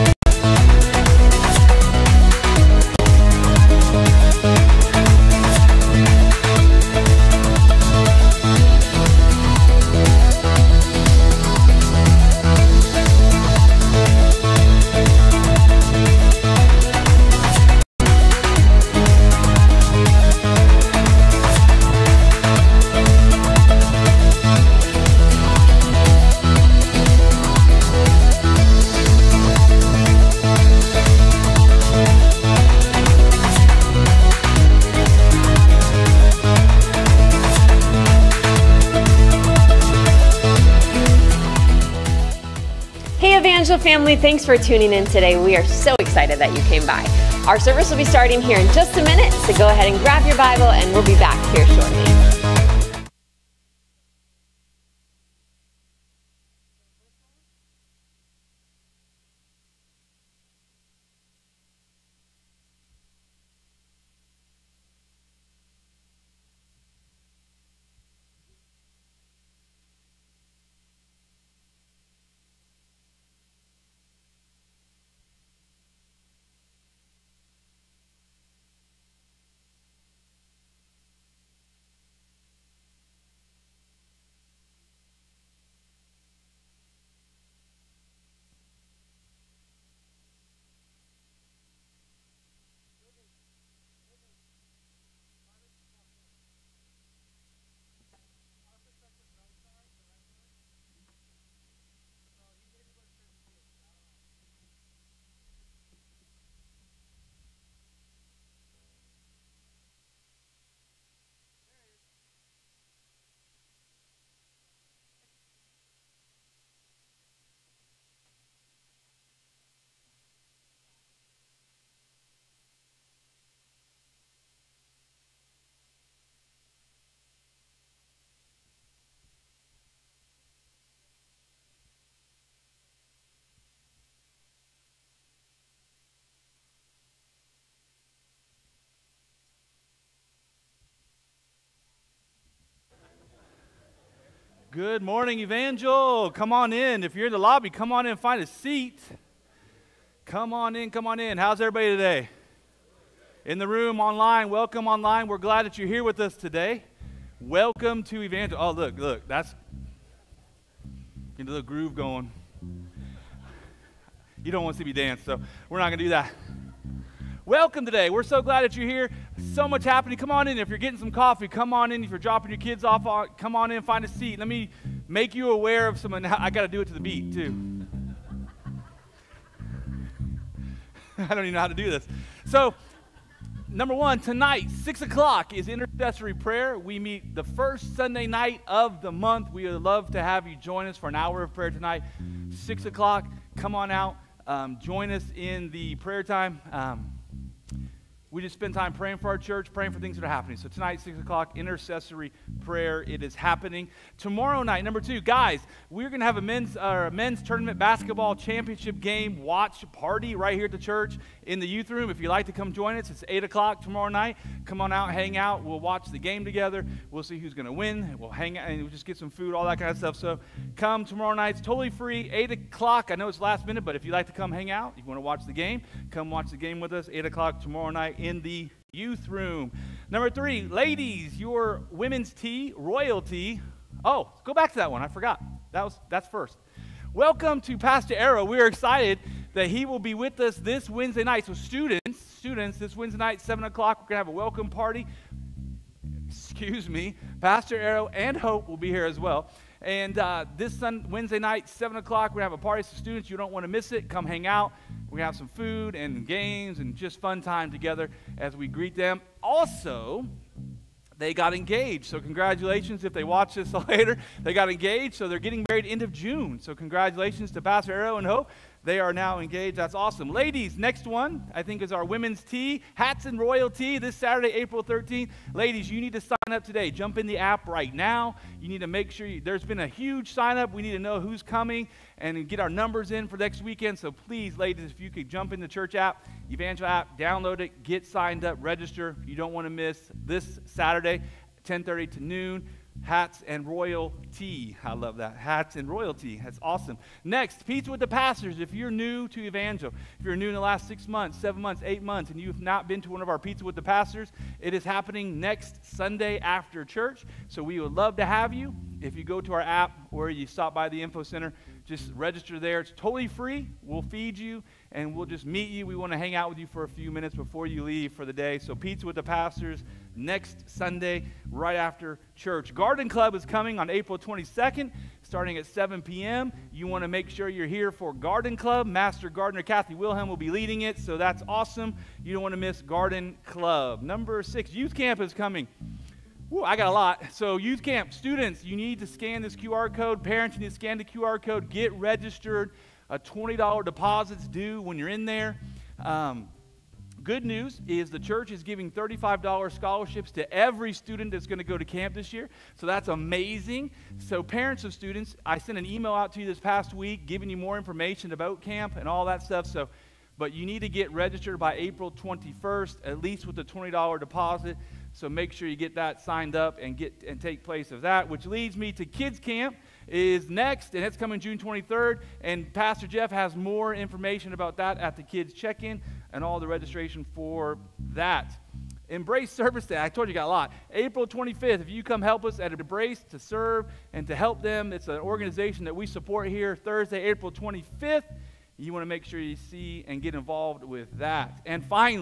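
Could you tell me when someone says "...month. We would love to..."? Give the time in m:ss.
3:09.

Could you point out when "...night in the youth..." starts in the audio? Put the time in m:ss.
3:47.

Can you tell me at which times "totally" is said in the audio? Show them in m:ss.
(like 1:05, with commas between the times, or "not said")
3:41, 5:12.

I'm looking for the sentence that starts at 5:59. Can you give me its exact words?
So, but you need to get registered by April 21st, at least with the $20 deposit.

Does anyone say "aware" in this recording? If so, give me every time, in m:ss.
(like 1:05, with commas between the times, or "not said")
2:55.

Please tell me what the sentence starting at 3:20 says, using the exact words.
So tonight, 6 o'clock, intercessory prayer.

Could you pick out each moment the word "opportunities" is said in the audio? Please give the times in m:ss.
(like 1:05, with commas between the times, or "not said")
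not said.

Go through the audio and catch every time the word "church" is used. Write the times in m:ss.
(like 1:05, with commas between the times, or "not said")
3:19, 3:30, 4:45, 5:06, 5:22, 5:48.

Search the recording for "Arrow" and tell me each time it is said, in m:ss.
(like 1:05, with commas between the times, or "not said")
3:58, 4:07, 4:27.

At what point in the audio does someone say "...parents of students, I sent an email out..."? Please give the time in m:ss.
5:54.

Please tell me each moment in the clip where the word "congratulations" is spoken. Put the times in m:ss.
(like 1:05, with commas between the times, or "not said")
4:22, 4:26.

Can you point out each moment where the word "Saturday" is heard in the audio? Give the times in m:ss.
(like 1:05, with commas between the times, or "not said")
4:34, 4:50.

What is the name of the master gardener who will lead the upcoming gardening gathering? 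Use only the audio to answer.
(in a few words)
Kathy Wilhelm.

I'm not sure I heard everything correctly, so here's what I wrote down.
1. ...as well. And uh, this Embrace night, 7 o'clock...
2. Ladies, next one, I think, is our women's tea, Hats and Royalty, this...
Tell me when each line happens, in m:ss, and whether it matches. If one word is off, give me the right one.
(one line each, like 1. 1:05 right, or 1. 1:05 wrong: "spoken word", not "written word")
1. 4:09 wrong: "Wednesday", not "Embrace"
2. 4:30 right.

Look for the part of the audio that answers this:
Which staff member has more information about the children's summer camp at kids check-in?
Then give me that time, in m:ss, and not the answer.
6:12.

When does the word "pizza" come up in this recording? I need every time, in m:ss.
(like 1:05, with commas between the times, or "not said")
4:57, 5:03, 5:18.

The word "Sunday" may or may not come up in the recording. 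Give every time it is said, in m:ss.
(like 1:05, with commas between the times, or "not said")
3:07, 5:05, 5:20.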